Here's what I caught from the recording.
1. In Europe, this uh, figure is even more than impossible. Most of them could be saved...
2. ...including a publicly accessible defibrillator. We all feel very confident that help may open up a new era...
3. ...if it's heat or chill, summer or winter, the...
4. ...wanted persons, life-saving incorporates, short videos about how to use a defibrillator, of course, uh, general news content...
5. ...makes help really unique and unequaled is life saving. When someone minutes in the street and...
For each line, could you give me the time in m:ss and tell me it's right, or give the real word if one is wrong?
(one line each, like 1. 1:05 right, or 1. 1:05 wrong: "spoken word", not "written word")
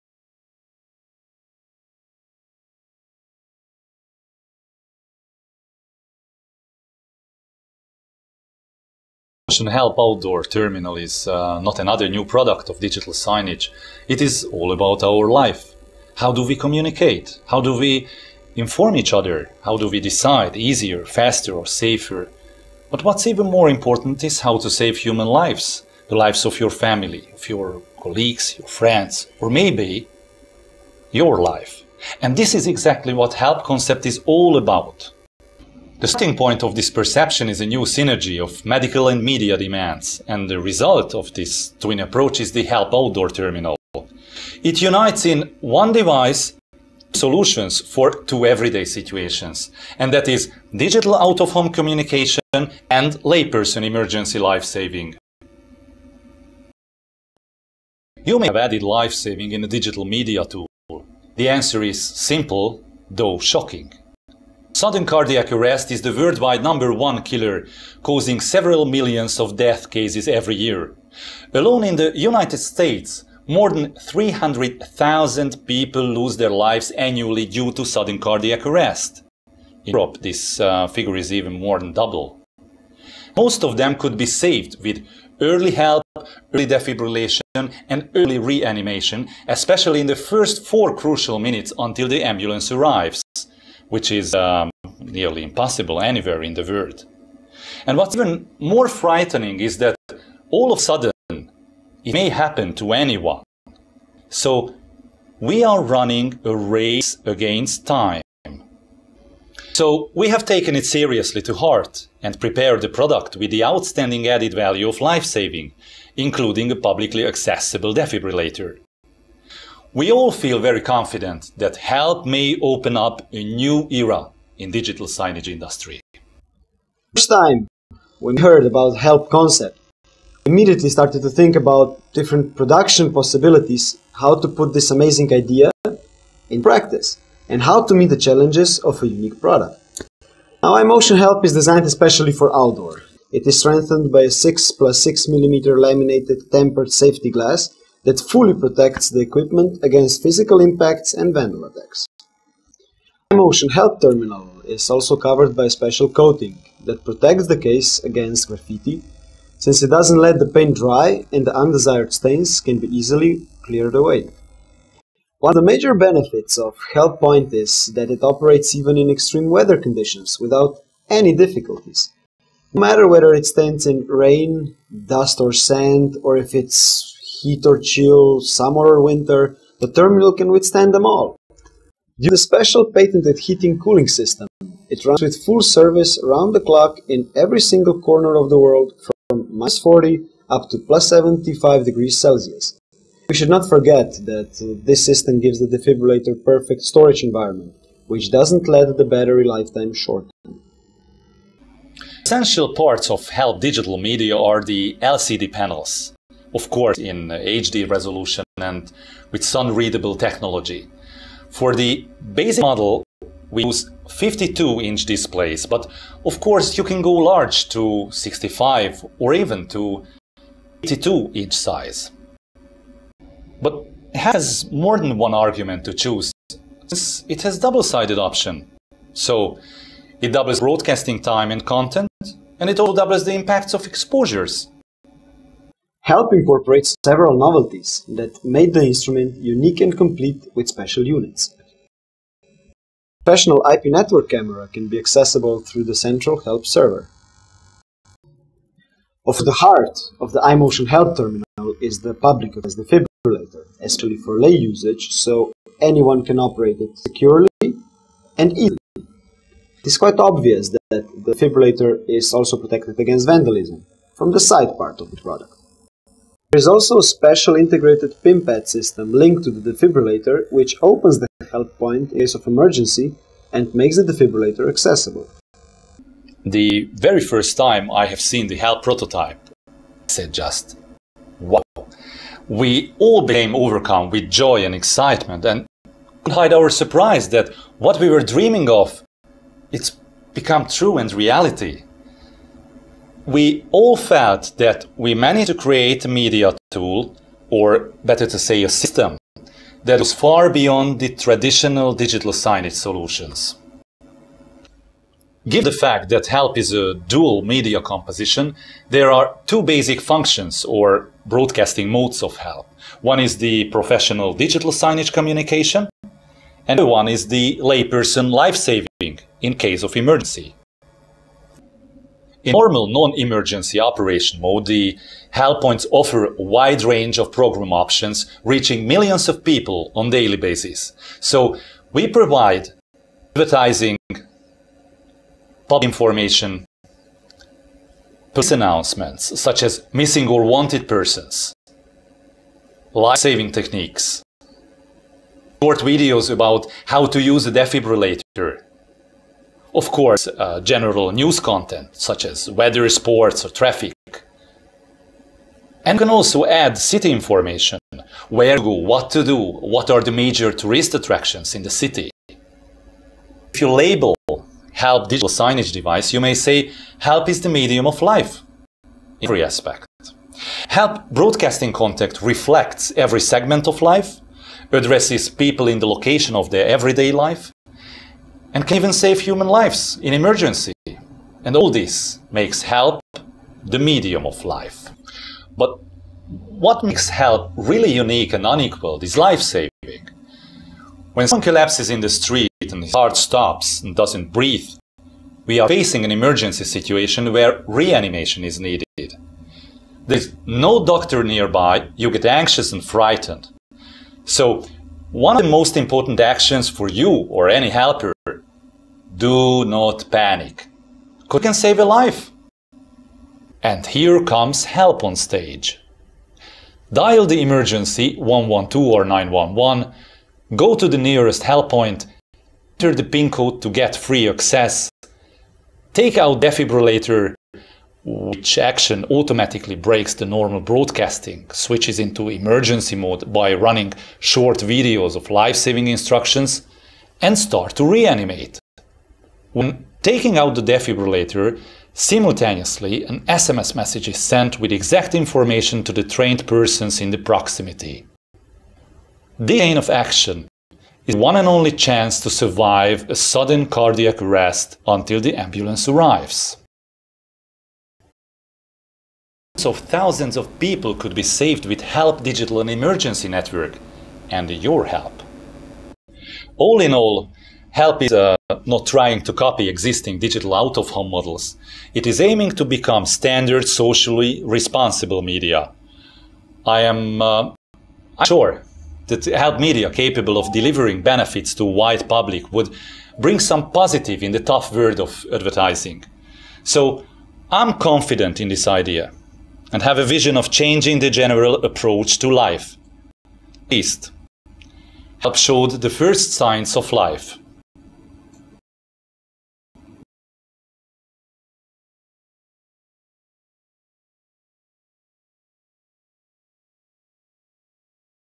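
1. 1:19 wrong: "double", not "impossible"
2. 1:56 right
3. 2:56 right
4. 5:40 wrong: "techniques", not "incorporates"
5. 6:26 wrong: "collapses", not "minutes".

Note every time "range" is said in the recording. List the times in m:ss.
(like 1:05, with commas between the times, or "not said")
5:26.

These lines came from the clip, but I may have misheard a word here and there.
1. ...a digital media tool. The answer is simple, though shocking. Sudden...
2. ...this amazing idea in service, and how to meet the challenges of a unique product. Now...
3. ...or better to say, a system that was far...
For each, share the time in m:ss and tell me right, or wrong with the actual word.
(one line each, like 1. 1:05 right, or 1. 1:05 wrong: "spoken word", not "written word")
1. 0:59 right
2. 2:14 wrong: "practice", not "service"
3. 4:57 right.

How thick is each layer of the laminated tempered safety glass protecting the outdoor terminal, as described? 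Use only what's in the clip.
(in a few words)
6 plus 6 mm.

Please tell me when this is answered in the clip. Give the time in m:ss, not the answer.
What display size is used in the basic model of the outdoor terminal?
3:34.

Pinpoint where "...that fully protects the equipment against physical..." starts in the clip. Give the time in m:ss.
2:28.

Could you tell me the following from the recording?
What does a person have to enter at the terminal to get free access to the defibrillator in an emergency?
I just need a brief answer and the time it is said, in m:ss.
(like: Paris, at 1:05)
PIN code, at 7:03.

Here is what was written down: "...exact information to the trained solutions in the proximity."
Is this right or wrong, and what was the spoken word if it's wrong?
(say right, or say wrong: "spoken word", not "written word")
wrong: "persons", not "solutions".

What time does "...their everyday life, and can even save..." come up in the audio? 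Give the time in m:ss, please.
6:16.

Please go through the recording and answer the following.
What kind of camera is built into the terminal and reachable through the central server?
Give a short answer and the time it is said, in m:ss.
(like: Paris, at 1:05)
IP network camera, at 4:03.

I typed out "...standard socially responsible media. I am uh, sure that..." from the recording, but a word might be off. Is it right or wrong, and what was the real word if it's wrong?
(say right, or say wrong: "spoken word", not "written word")
right.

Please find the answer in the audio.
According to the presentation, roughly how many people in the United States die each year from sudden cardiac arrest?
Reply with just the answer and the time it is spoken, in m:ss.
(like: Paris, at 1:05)
300,000, at 1:14.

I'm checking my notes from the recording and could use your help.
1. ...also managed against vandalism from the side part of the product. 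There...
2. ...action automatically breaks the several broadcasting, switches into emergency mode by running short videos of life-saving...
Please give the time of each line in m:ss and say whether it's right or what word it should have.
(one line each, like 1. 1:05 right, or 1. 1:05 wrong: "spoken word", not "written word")
1. 4:22 wrong: "protected", not "managed"
2. 7:08 wrong: "normal", not "several".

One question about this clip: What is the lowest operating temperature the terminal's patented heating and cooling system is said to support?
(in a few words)
minus 40 degrees Celsius.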